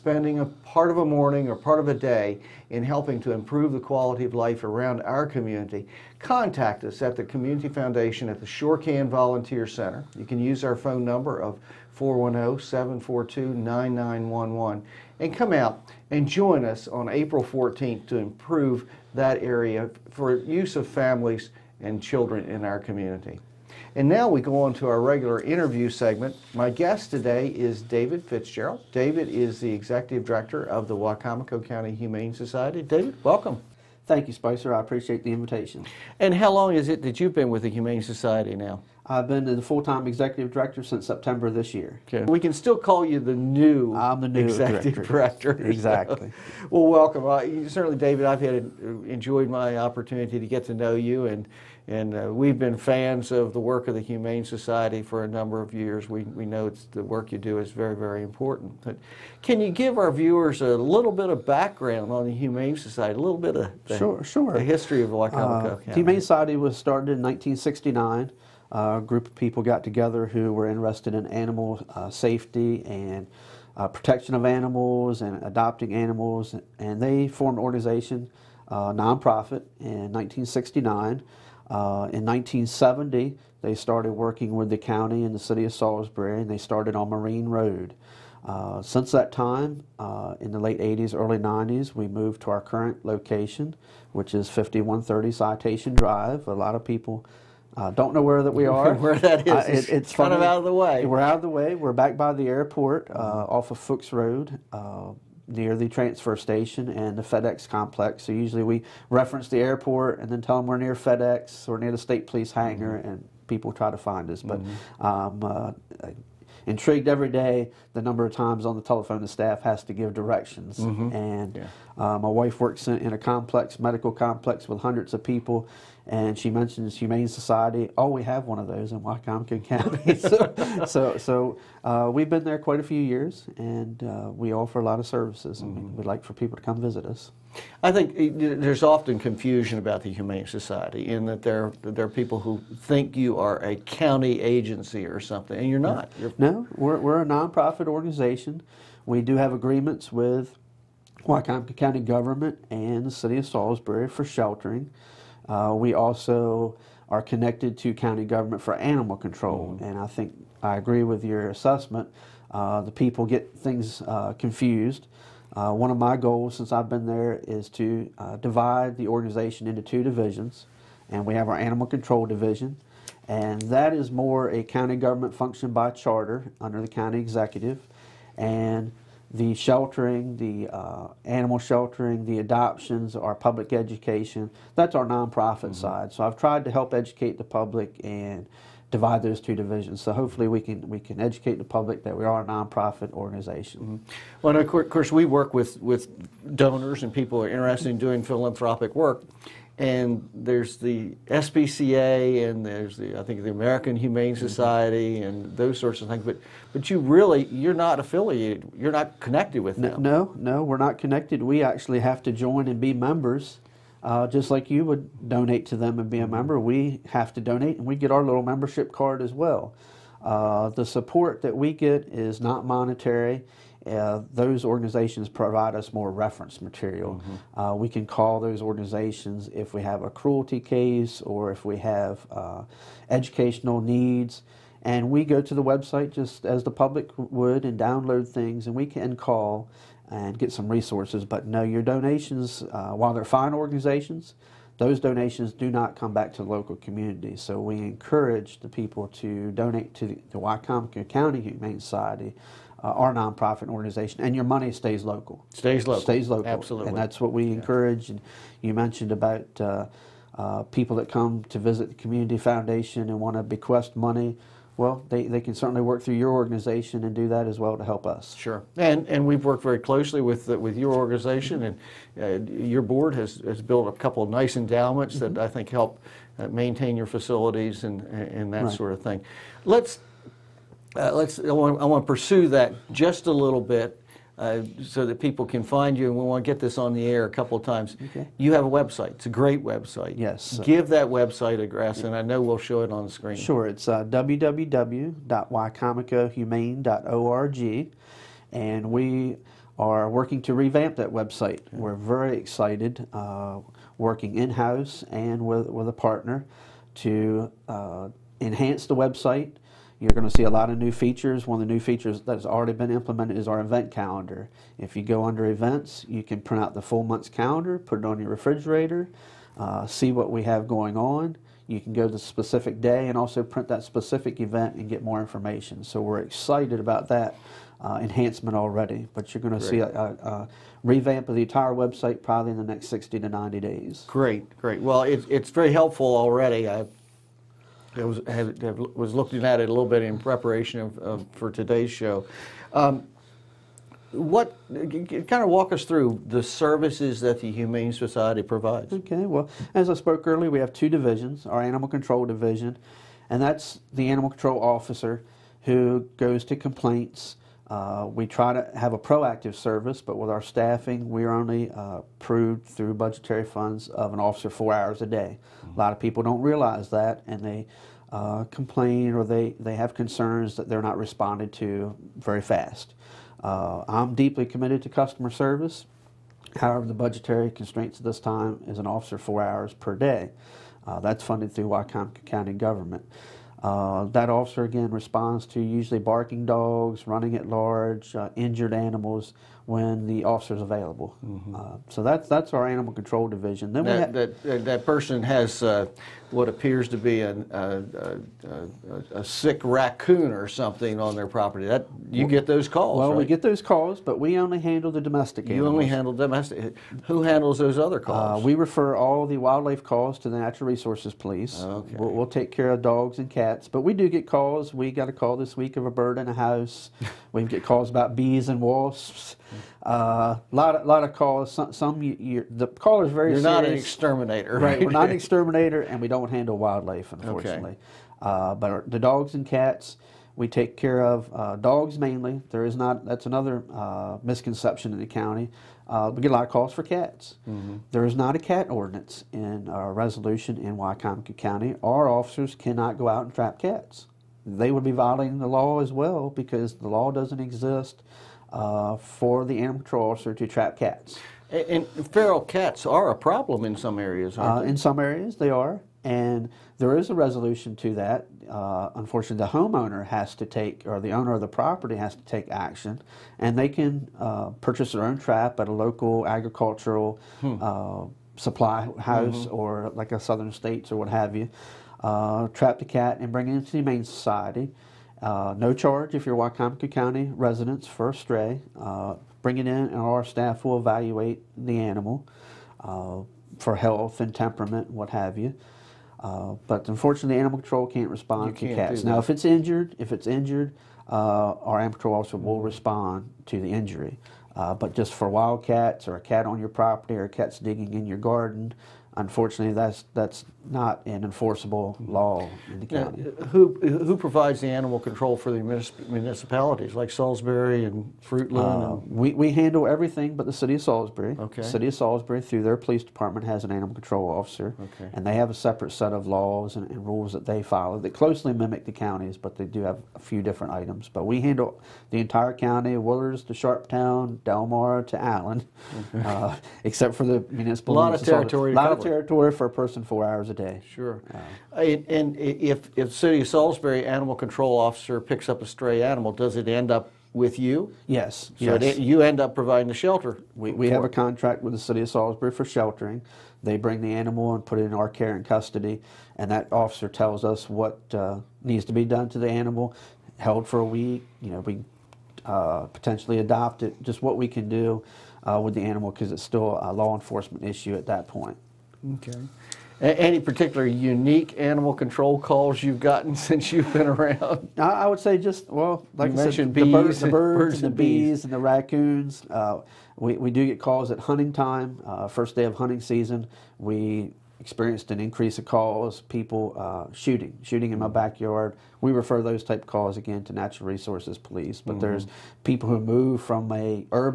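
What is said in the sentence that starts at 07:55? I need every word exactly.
Uh, no charge if you're Wicomico County residents for a stray.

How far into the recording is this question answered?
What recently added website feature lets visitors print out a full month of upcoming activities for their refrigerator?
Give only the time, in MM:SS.
05:13.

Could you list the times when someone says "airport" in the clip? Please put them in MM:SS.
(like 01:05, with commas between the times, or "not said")
01:42, 01:49.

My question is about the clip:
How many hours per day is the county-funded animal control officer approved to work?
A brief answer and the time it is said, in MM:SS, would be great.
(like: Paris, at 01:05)
4, at 06:04.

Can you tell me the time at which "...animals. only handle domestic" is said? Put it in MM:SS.
06:45.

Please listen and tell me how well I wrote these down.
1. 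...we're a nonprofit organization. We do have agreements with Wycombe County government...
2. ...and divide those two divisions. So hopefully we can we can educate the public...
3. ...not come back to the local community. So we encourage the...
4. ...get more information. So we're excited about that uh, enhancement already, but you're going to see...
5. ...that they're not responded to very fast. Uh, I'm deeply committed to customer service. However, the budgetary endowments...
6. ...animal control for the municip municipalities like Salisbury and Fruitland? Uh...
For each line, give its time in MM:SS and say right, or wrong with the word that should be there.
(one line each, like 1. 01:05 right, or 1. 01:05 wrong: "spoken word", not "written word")
1. 02:26 right
2. 03:08 right
3. 04:05 right
4. 05:24 right
5. 06:10 wrong: "constraints", not "endowments"
6. 08:24 right.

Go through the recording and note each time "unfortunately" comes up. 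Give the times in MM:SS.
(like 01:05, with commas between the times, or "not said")
07:07, 07:38, 08:06, 08:19.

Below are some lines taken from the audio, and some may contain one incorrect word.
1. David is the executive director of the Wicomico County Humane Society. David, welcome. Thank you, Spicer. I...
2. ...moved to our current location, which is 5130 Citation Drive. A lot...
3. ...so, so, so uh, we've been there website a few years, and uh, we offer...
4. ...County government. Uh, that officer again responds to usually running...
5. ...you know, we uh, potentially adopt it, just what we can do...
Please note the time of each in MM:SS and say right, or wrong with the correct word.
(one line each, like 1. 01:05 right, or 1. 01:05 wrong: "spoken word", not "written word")
1. 00:28 right
2. 01:32 right
3. 02:10 wrong: "quite", not "website"
4. 06:22 wrong: "barking", not "running"
5. 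09:11 right.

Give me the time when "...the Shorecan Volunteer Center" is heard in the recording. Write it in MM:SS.
00:08.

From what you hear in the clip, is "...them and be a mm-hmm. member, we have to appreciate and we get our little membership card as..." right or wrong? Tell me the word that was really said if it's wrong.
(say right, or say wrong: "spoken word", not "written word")
wrong: "donate", not "appreciate".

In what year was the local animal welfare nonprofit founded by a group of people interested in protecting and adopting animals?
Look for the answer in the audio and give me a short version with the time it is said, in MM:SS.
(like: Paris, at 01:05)
1969, at 01:05.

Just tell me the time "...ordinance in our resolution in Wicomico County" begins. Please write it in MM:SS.
07:18.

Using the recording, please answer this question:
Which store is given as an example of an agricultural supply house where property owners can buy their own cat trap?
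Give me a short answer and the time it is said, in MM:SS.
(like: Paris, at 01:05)
Southern States, at 07:49.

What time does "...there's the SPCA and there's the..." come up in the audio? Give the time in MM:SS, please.
03:20.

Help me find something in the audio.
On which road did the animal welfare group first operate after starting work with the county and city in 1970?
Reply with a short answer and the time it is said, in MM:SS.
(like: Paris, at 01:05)
Marine Road, at 01:26.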